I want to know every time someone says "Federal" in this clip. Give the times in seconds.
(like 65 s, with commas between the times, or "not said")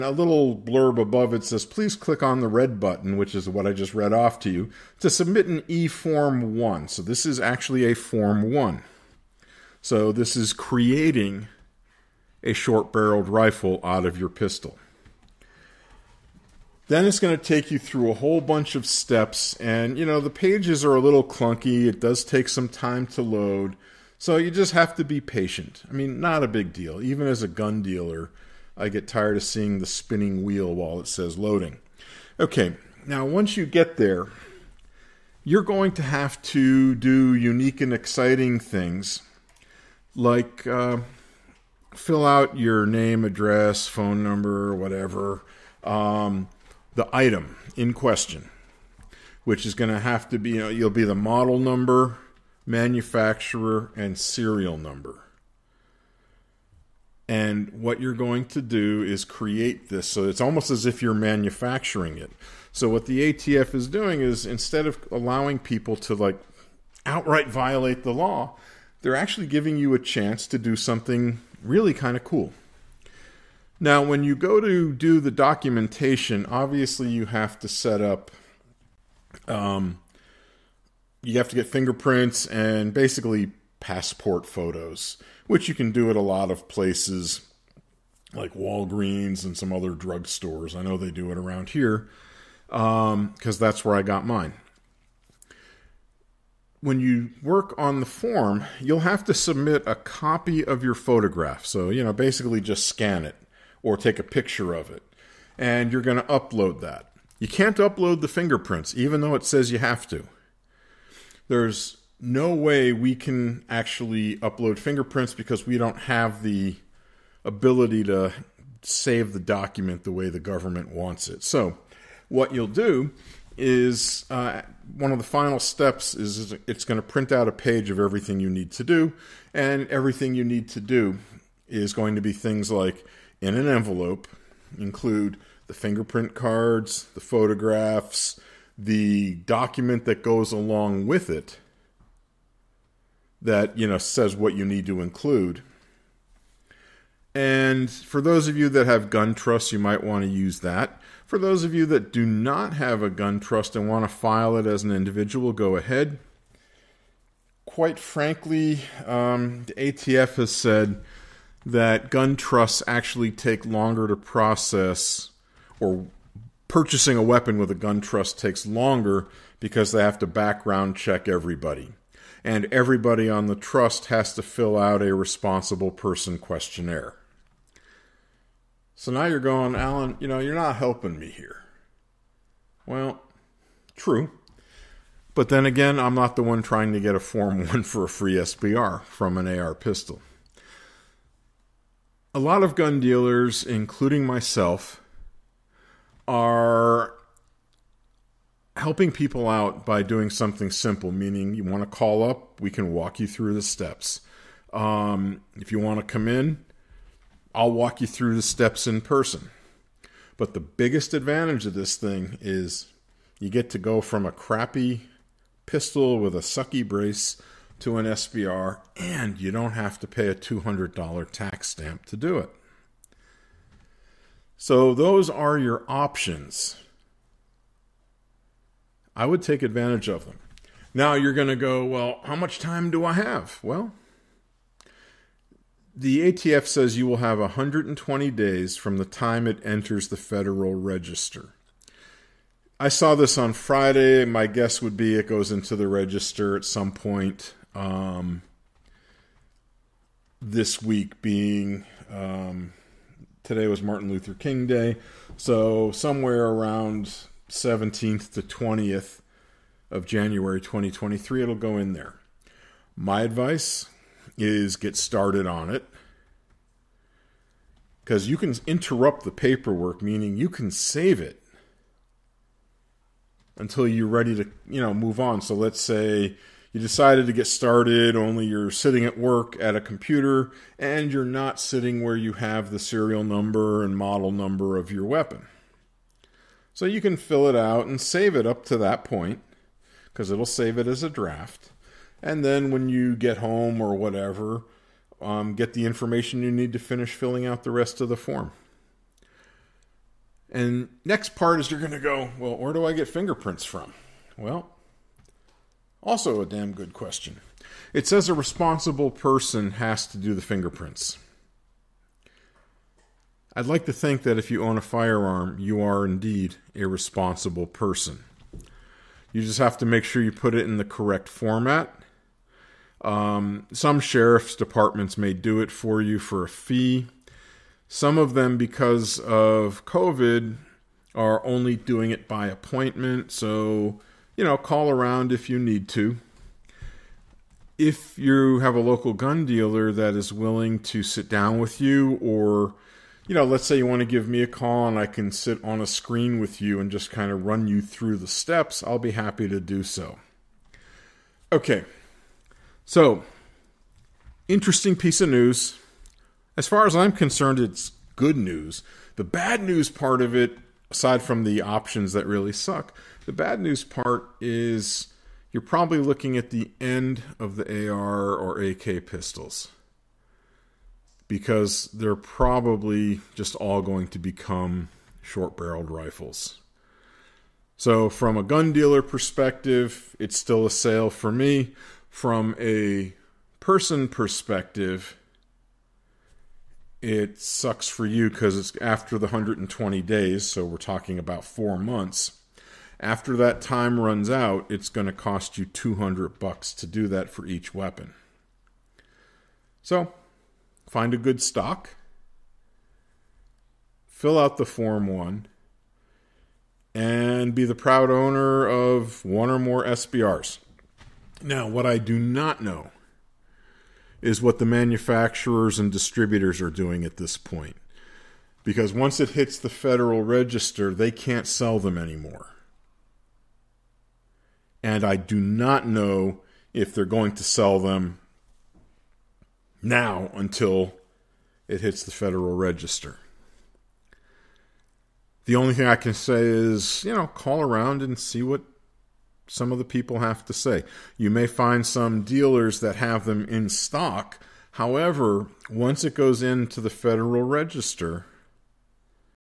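240 s, 419 s, 432 s, 446 s.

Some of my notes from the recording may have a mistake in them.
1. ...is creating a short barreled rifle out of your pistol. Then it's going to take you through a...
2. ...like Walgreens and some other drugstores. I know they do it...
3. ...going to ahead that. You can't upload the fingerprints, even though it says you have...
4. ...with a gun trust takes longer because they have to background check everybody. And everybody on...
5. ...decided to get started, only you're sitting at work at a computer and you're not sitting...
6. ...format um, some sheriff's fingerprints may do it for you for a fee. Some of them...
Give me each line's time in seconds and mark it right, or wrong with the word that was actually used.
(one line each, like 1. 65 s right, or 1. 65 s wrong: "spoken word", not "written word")
1. 10 s right
2. 88 s right
3. 106 s wrong: "upload", not "ahead"
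4. 167 s right
5. 276 s right
6. 321 s wrong: "departments", not "fingerprints".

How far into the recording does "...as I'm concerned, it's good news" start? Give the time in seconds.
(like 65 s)
356 s.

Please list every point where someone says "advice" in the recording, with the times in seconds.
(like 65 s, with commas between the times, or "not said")
263 s.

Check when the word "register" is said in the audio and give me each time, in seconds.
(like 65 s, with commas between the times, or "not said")
240 s, 245 s, 420 s, 432 s, 447 s.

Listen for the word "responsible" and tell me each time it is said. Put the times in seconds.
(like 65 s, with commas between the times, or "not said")
175 s, 308 s, 316 s.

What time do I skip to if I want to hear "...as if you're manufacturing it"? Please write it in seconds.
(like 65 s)
60 s.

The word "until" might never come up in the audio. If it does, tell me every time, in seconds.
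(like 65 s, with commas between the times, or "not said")
273 s, 430 s.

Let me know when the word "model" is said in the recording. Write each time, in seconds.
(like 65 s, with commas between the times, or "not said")
51 s, 283 s.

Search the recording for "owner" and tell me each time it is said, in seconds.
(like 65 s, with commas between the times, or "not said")
408 s.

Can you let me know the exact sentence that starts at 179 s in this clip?
So now you're going, Alan, you know, you're not helping me here.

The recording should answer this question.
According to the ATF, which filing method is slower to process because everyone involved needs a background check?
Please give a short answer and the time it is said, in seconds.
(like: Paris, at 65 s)
gun trusts, at 162 s.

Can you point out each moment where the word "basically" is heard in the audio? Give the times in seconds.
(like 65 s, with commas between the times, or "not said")
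82 s, 102 s.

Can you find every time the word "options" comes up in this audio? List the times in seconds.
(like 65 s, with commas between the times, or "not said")
225 s, 361 s.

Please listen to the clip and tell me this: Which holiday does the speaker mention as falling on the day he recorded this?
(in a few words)
Martin Luther King Day.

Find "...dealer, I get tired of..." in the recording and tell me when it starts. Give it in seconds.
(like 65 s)
27 s.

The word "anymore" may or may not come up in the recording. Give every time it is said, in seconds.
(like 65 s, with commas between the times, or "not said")
421 s.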